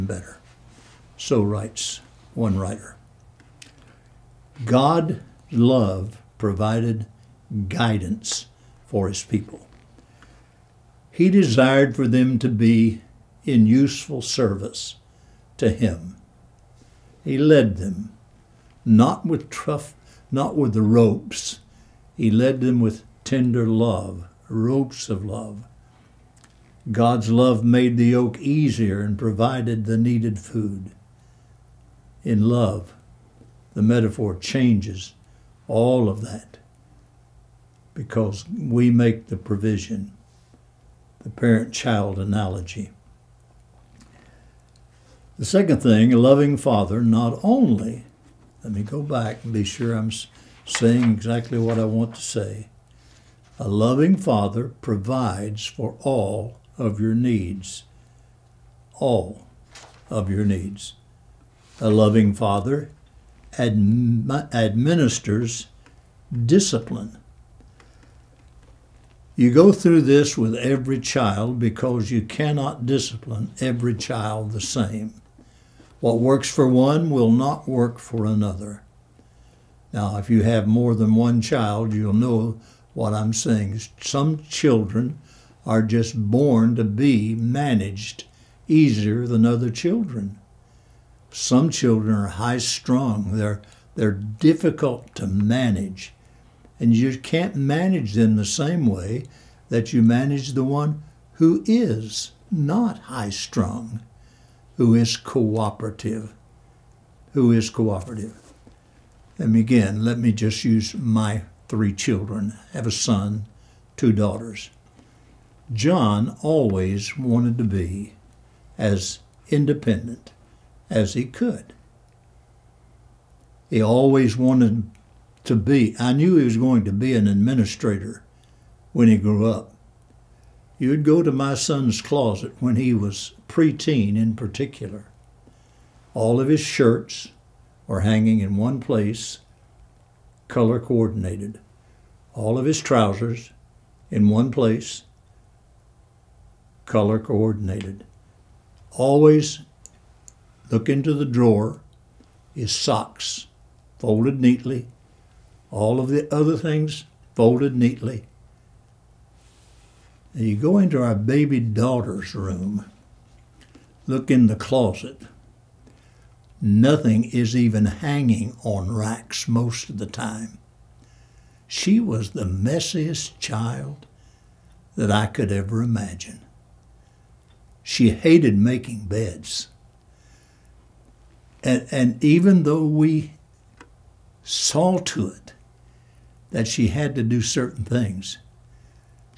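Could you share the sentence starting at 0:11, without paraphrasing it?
He desired for them to be in useful service to him.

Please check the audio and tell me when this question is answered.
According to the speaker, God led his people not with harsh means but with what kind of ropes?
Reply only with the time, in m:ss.
0:24.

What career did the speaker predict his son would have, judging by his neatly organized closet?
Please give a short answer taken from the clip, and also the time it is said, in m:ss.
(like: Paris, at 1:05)
Administrator, at 2:07.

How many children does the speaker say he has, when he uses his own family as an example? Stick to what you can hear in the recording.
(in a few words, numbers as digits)
3.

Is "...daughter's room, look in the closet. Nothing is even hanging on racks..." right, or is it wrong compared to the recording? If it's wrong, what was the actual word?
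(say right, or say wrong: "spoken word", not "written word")
right.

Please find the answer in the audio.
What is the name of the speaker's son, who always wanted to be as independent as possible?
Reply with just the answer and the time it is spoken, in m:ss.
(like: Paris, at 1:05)
John, at 1:55.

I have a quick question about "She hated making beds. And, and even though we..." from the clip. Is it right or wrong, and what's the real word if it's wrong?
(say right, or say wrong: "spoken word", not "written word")
right.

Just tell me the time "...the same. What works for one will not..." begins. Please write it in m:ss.
1:14.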